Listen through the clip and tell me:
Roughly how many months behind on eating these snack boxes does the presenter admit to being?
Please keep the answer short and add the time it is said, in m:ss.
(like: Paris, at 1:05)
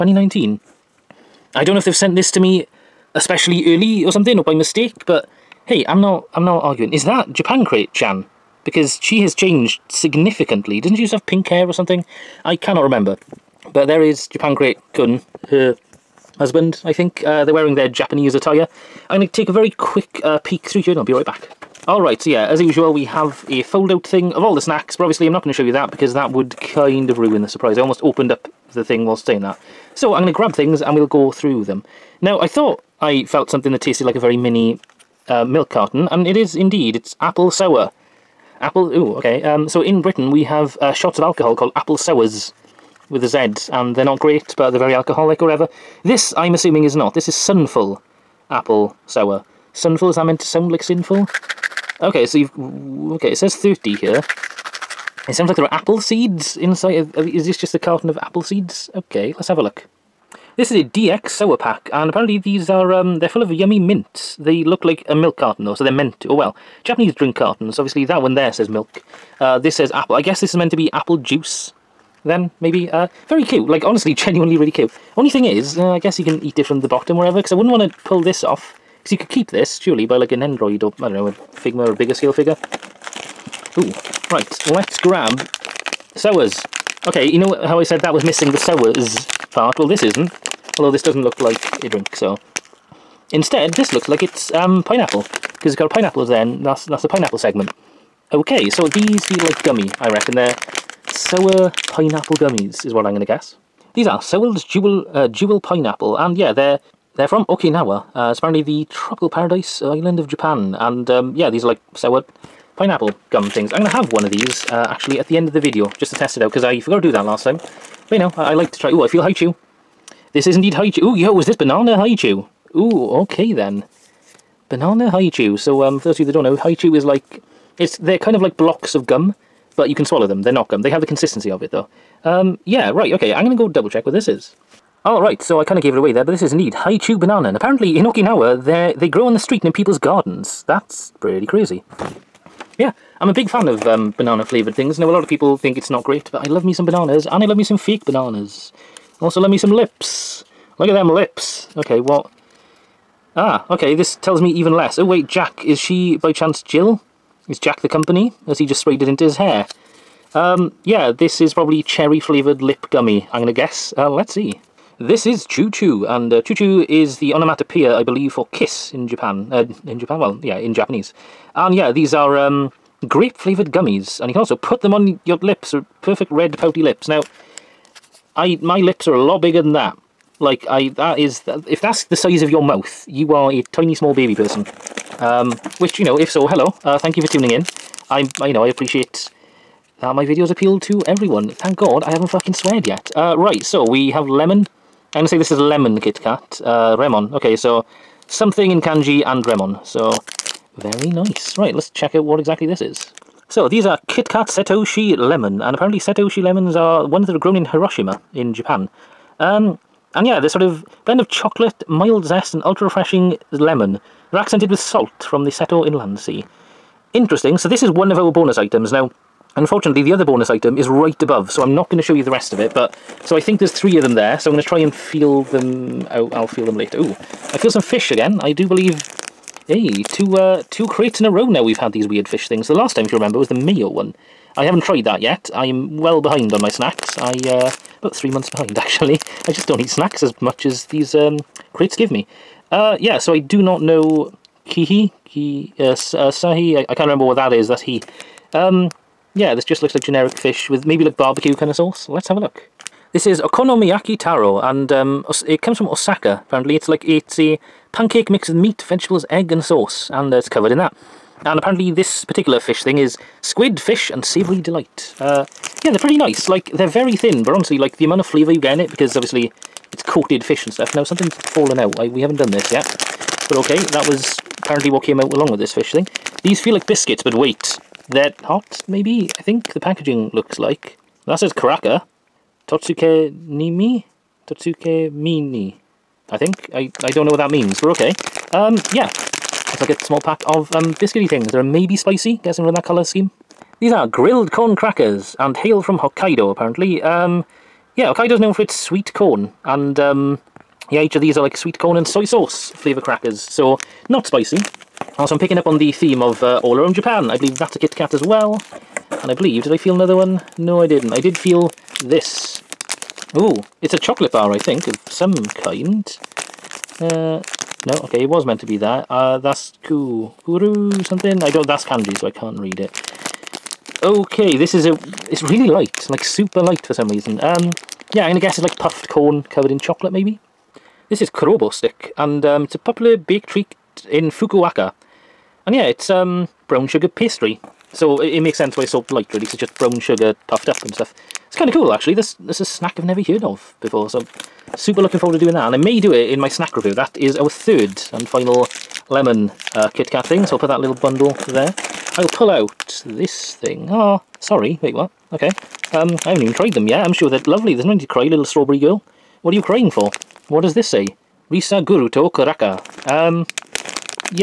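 3, at 3:58.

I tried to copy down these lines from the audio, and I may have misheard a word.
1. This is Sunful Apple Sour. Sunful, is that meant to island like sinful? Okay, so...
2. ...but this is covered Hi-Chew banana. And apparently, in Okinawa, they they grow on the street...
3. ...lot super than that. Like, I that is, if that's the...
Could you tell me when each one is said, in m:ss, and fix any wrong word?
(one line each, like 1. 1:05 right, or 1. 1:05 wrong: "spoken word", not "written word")
1. 0:47 wrong: "sound", not "island"
2. 2:16 wrong: "indeed", not "covered"
3. 2:59 wrong: "bigger", not "super".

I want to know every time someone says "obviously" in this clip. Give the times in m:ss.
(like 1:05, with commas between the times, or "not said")
0:25, 1:07, 4:29.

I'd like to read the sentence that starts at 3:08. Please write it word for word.
I'm, I, you know, I appreciate that my videos appeal to everyone.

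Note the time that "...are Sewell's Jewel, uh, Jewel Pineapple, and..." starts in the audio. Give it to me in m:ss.
1:44.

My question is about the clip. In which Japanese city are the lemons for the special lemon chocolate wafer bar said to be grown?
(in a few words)
Hiroshima.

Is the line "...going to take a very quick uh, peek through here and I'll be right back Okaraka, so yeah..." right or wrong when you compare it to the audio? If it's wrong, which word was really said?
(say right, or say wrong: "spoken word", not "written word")
wrong: "Alright", not "Okaraka".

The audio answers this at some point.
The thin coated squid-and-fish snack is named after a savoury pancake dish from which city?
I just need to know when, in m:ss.
4:15.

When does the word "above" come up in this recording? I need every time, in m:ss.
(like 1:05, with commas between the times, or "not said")
3:41.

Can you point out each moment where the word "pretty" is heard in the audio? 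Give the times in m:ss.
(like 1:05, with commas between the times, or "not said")
2:21, 4:25.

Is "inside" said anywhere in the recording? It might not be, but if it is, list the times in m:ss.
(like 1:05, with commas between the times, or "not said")
0:56.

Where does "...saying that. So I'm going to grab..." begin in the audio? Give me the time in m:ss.
0:29.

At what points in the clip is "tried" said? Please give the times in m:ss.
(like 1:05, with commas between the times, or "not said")
3:54, 5:56.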